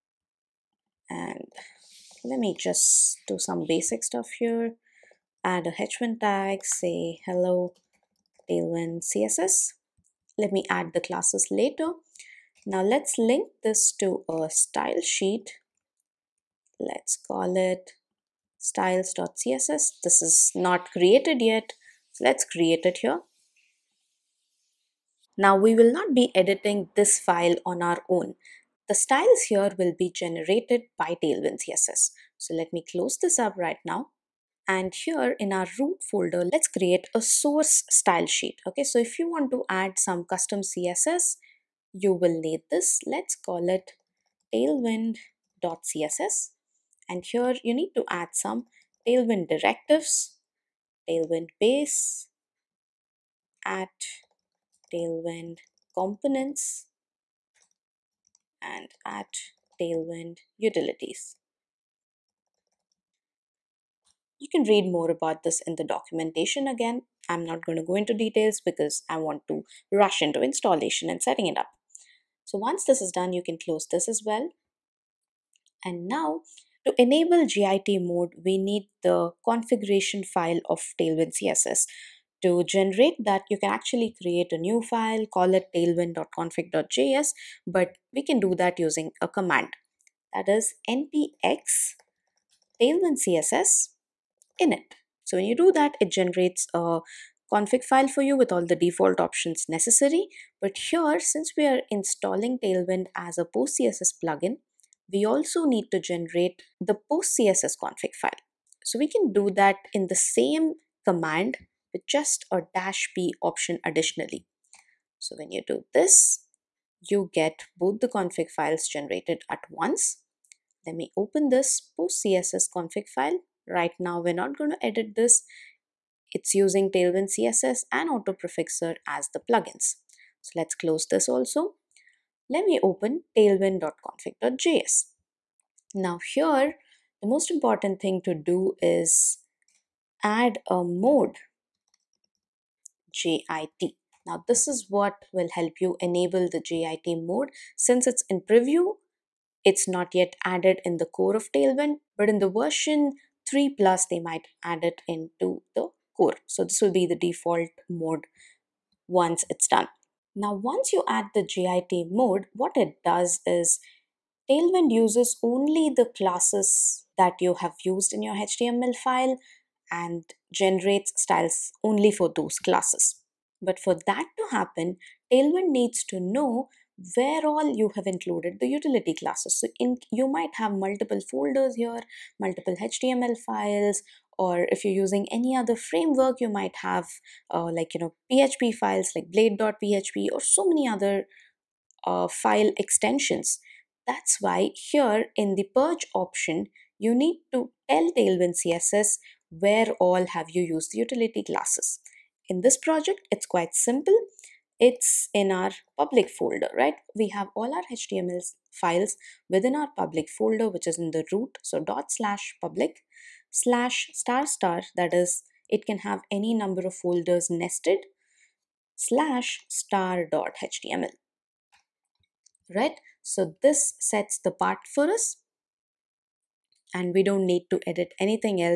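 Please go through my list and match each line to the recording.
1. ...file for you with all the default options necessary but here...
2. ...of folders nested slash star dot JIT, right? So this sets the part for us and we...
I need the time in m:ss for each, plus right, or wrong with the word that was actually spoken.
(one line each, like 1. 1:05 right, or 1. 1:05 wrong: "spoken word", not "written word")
1. 1:37 right
2. 3:36 wrong: "HTML", not "JIT".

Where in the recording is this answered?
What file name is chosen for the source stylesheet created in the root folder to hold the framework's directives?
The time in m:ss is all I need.
0:44.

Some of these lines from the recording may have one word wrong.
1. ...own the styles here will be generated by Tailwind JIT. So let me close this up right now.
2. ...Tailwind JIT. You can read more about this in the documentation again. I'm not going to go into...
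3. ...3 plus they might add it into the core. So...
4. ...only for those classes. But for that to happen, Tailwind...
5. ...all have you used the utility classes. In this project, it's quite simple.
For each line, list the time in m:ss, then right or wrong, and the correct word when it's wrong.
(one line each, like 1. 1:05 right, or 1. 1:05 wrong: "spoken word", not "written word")
1. 0:28 wrong: "CSS", not "JIT"
2. 0:59 wrong: "Utilities", not "JIT"
3. 2:33 right
4. 2:51 right
5. 3:19 right.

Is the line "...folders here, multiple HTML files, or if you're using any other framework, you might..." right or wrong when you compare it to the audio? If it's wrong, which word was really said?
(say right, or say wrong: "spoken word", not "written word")
right.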